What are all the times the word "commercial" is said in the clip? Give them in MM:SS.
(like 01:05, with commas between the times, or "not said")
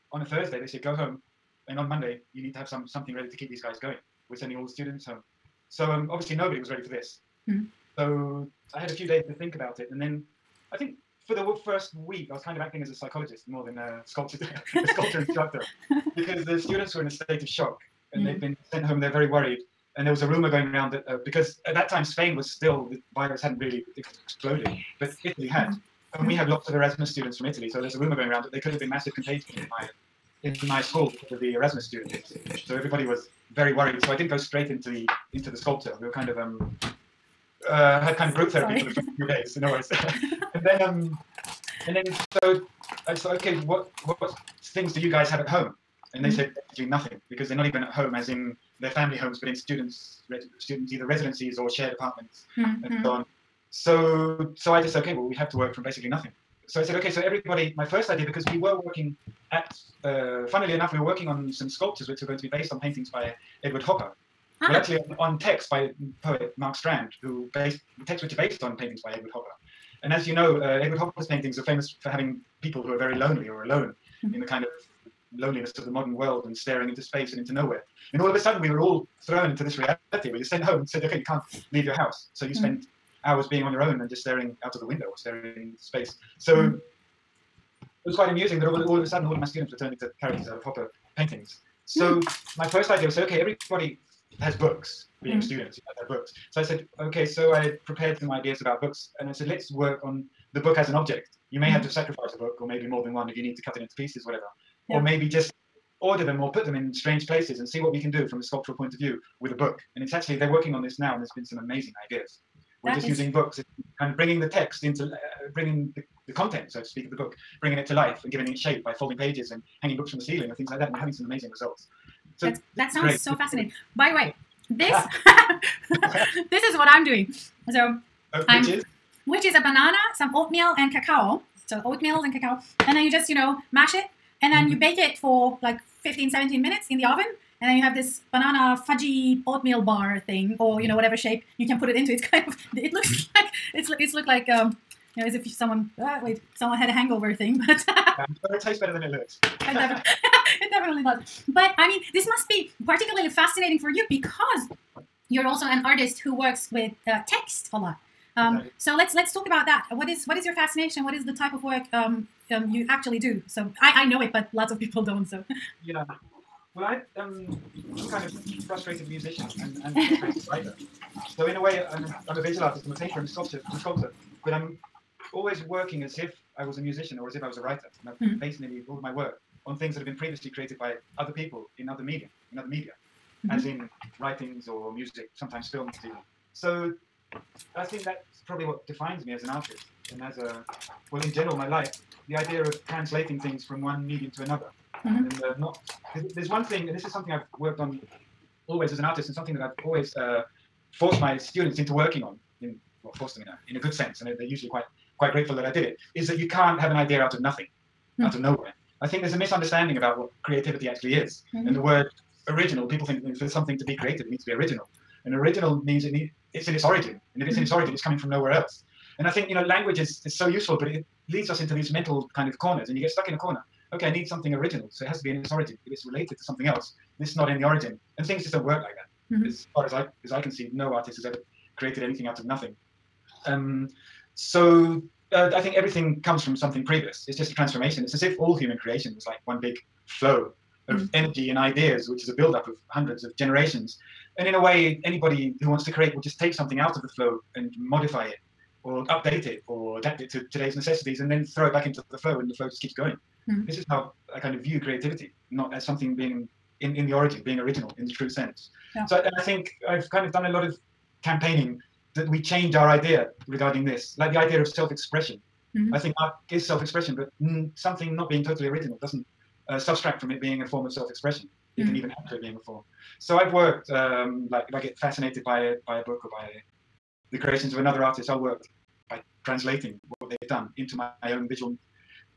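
not said.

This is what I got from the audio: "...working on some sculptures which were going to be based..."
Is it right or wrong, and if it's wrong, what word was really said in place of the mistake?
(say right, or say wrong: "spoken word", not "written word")
right.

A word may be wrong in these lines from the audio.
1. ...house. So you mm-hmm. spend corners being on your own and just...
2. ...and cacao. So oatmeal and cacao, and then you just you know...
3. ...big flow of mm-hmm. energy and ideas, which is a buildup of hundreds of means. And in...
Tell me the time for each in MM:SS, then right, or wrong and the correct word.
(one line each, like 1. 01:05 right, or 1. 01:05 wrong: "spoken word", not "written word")
1. 01:21 wrong: "hours", not "corners"
2. 02:10 right
3. 03:59 wrong: "generations", not "means".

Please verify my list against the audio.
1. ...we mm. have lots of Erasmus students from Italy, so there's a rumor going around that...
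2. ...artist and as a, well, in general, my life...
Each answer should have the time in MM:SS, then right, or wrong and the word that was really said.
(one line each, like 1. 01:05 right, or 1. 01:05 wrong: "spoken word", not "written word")
1. 00:26 right
2. 03:09 right.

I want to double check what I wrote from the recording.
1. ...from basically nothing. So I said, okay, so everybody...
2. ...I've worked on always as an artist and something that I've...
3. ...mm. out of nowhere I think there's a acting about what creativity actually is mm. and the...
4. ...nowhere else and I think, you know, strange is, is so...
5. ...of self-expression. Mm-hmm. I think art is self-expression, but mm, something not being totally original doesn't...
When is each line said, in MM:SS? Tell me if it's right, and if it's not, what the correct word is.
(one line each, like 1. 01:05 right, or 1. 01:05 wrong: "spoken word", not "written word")
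1. 00:55 right
2. 03:17 right
3. 03:28 wrong: "misunderstanding", not "acting"
4. 03:38 wrong: "language", not "strange"
5. 04:24 right.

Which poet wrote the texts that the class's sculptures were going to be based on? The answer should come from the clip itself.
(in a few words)
Mark Strand.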